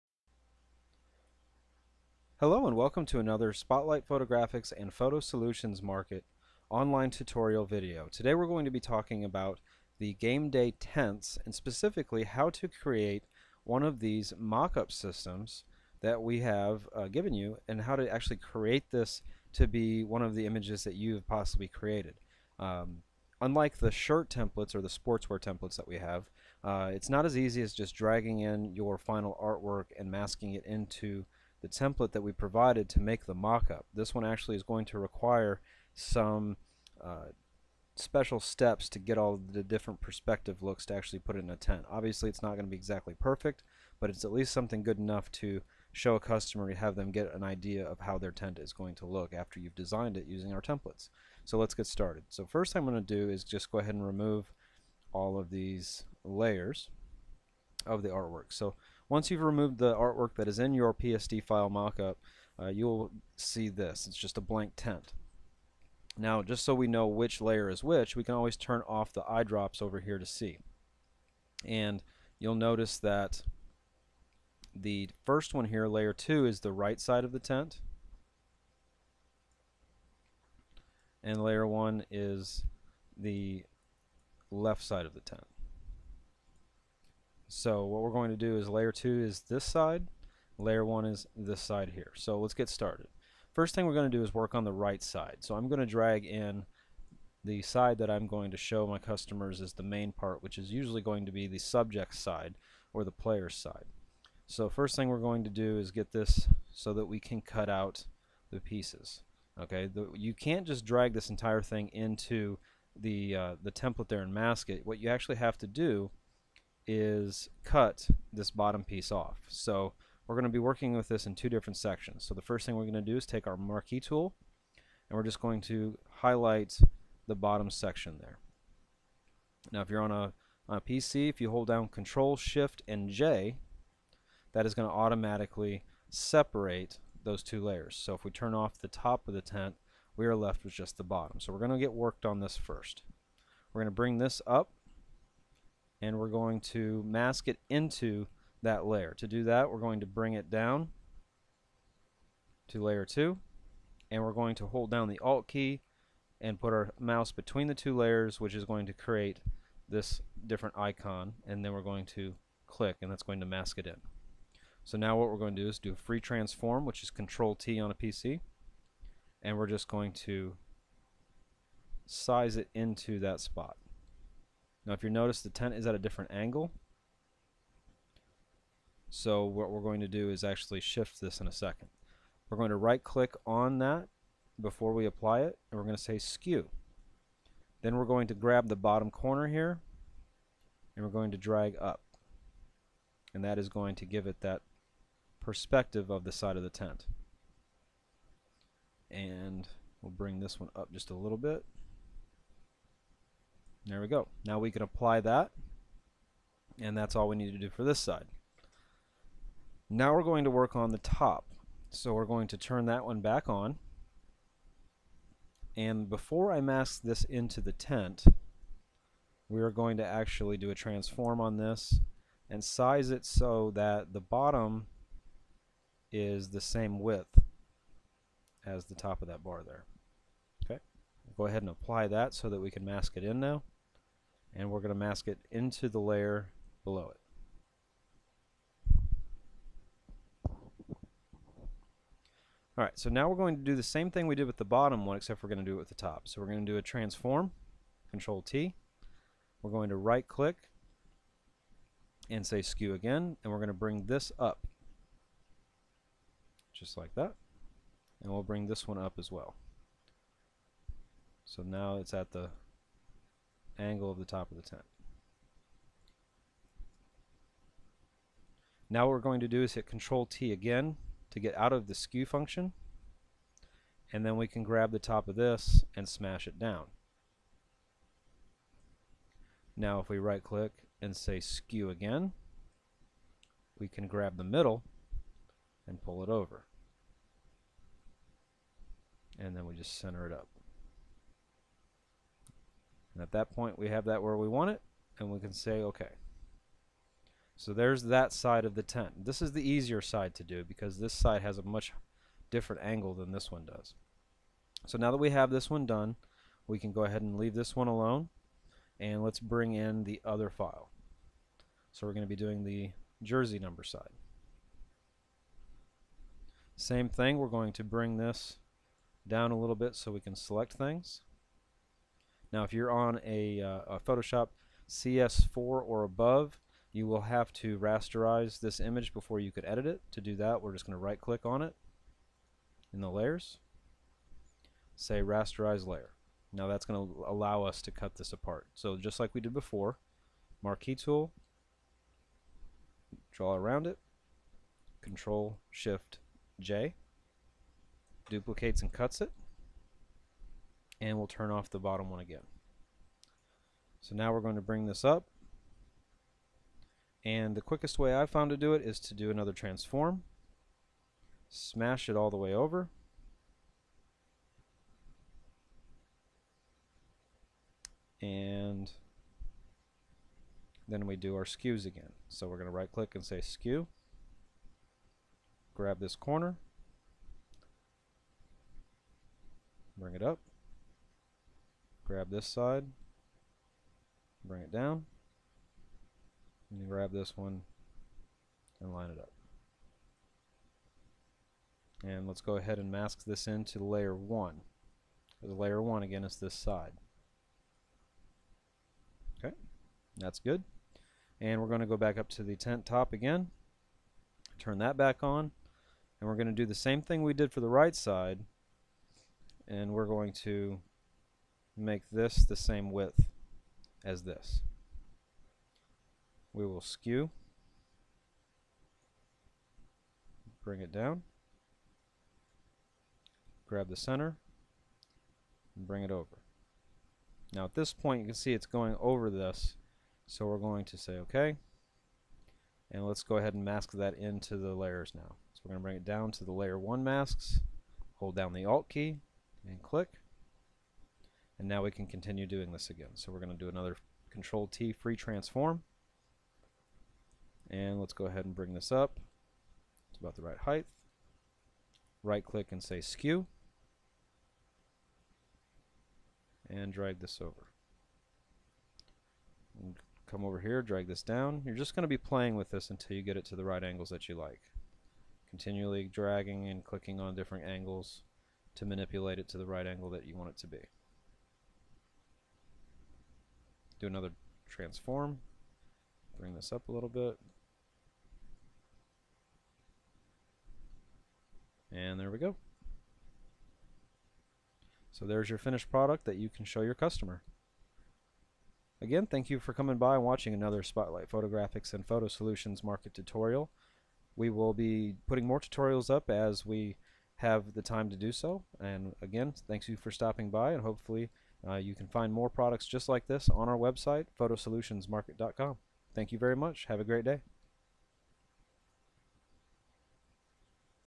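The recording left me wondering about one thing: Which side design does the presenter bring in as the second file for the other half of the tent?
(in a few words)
Jersey number side.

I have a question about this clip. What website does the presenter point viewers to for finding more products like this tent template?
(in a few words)
photosolutionsmarket.com.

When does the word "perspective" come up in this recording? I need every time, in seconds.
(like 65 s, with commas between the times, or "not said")
40 s, 195 s.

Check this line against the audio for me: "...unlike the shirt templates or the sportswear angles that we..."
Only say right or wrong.
wrong.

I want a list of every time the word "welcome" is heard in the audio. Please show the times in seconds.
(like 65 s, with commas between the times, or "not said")
2 s.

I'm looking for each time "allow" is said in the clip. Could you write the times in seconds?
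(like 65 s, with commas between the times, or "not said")
337 s.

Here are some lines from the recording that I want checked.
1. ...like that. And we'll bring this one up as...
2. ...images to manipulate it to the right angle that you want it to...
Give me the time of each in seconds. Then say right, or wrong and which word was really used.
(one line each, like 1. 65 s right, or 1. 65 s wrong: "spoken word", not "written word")
1. 256 s right
2. 467 s wrong: "angles", not "images".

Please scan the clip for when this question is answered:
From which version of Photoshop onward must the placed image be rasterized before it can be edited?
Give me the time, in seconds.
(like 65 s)
324 s.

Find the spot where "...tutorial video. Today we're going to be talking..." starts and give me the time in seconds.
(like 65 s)
7 s.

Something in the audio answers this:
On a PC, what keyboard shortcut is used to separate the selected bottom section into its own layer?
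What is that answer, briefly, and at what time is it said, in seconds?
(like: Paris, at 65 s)
Control Shift J, at 131 s.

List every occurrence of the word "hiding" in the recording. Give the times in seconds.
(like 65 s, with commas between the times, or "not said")
not said.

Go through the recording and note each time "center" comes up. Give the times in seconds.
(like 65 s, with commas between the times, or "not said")
289 s, 423 s.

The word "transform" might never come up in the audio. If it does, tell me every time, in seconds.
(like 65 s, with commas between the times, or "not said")
166 s, 220 s, 246 s, 359 s, 445 s, 474 s.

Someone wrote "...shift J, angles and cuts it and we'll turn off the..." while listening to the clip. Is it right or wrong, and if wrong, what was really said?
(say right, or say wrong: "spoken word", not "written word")
wrong: "duplicates", not "angles".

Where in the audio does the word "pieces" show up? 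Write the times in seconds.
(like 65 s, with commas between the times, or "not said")
108 s, 118 s.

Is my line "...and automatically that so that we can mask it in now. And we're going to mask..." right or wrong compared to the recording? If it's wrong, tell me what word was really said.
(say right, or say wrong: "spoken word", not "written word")
wrong: "apply", not "automatically".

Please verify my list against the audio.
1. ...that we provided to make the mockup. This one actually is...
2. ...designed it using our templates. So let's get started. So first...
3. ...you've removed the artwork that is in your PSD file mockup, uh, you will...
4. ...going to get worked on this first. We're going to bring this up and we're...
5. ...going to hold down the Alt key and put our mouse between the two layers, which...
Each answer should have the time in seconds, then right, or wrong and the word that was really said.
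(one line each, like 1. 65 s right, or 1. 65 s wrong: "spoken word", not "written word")
1. 32 s right
2. 49 s right
3. 59 s right
4. 141 s right
5. 154 s right.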